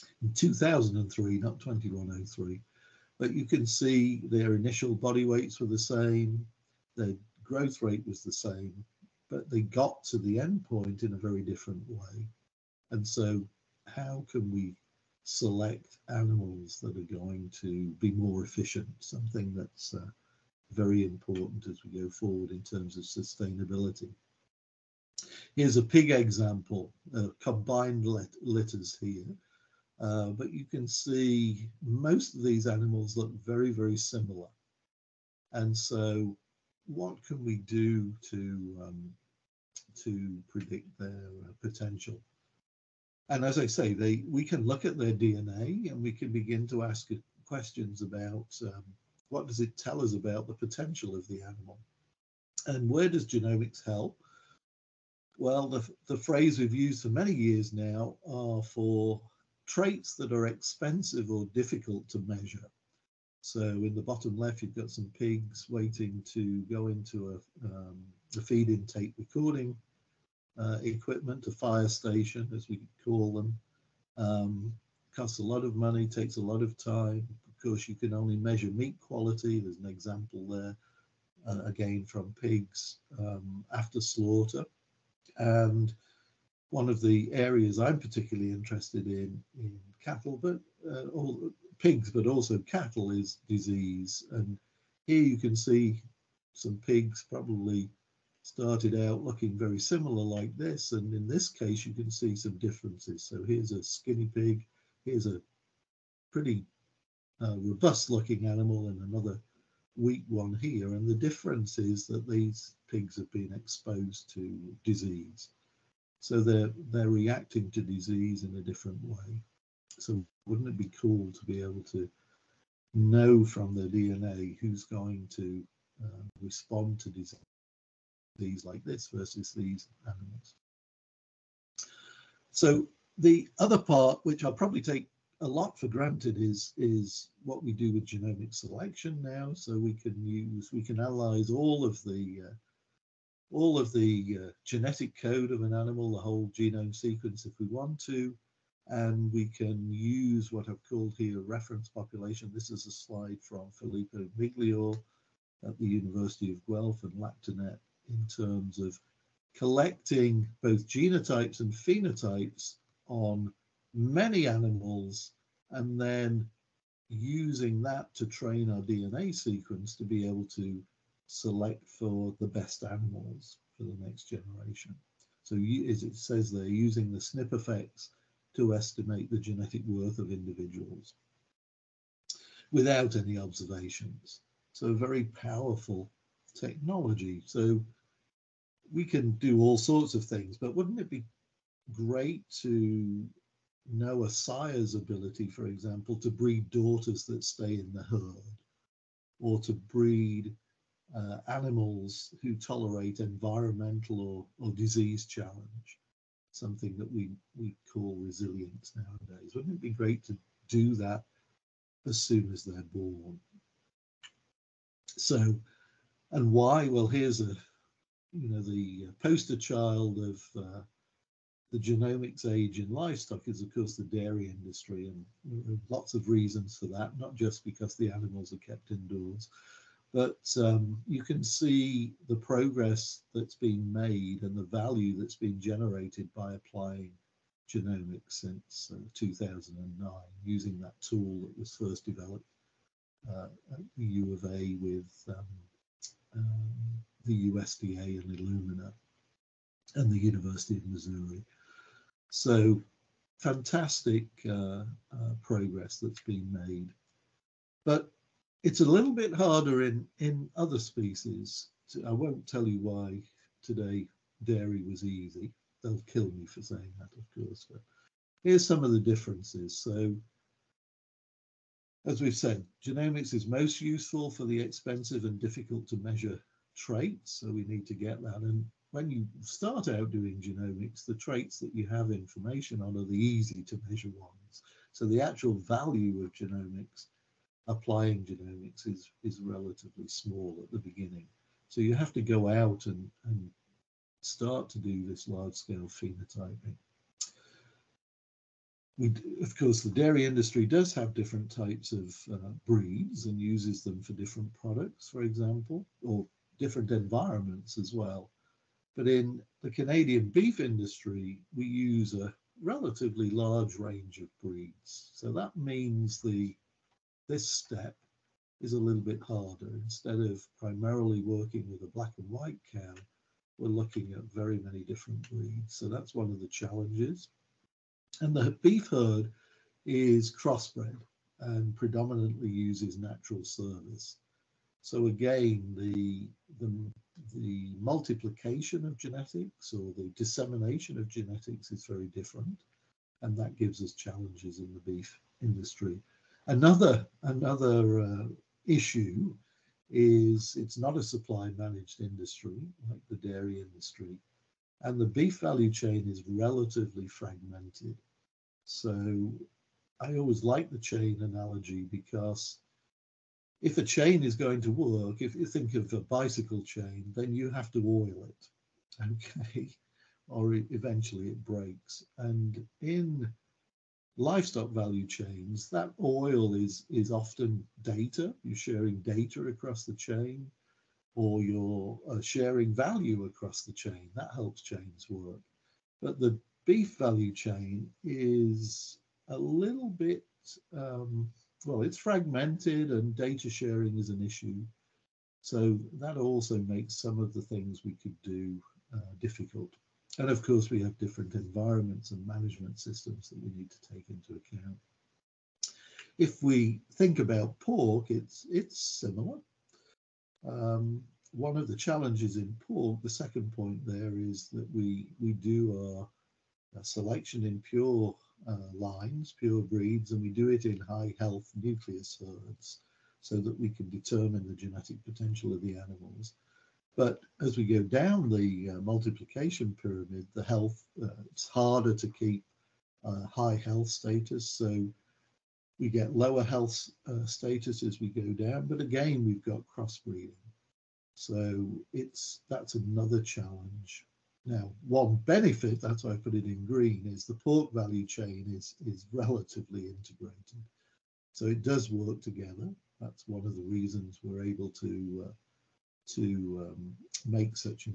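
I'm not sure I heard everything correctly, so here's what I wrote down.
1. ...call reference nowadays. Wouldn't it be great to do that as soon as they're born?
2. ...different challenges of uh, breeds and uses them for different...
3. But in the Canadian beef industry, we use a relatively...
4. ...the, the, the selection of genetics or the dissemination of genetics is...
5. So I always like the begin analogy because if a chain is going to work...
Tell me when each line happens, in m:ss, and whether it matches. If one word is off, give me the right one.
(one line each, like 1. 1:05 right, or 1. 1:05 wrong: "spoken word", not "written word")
1. 3:27 wrong: "resilience", not "reference"
2. 5:01 wrong: "types", not "challenges"
3. 5:08 right
4. 5:35 wrong: "multiplication", not "selection"
5. 5:58 wrong: "chain", not "begin".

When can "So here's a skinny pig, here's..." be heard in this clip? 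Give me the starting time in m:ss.
1:43.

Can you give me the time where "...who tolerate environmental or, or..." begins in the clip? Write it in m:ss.
3:22.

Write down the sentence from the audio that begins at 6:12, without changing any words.
And in livestock value chains, that oil is, is often data.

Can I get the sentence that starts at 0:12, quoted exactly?
And so, how can we select animals that are going to be more efficient?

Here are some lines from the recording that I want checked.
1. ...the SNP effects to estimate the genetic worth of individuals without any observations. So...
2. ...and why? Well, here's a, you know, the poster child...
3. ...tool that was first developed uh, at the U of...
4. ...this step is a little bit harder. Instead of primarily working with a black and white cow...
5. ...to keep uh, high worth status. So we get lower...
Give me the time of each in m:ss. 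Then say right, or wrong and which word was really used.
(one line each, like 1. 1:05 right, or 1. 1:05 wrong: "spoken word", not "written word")
1. 2:57 right
2. 3:36 right
3. 4:00 right
4. 5:17 right
5. 7:11 wrong: "health", not "worth".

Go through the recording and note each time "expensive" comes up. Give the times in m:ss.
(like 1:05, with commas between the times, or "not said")
1:00, 4:34.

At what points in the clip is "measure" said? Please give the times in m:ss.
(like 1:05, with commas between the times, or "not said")
1:02, 1:18, 4:35, 4:43.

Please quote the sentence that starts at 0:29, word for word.
Uh, but you can see most of these animals look very, very similar.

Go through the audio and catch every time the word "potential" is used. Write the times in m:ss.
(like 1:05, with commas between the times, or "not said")
0:41, 0:50, 7:05.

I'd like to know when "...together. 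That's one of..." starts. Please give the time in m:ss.
7:32.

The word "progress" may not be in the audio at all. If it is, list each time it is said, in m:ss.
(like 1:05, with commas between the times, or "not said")
3:52, 4:15.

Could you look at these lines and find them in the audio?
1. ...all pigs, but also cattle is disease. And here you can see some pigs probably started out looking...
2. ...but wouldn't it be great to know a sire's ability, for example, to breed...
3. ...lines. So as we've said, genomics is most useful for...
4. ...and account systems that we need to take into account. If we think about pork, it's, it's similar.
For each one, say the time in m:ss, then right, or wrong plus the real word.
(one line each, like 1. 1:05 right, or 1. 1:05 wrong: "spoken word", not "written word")
1. 1:31 right
2. 3:10 right
3. 4:28 wrong: "differences", not "lines"
4. 6:42 wrong: "management", not "account".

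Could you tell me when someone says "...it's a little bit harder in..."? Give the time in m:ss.
4:18.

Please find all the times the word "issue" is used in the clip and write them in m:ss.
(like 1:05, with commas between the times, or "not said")
5:48, 6:34.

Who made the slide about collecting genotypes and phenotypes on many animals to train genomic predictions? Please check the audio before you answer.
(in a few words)
Filippo Miglior.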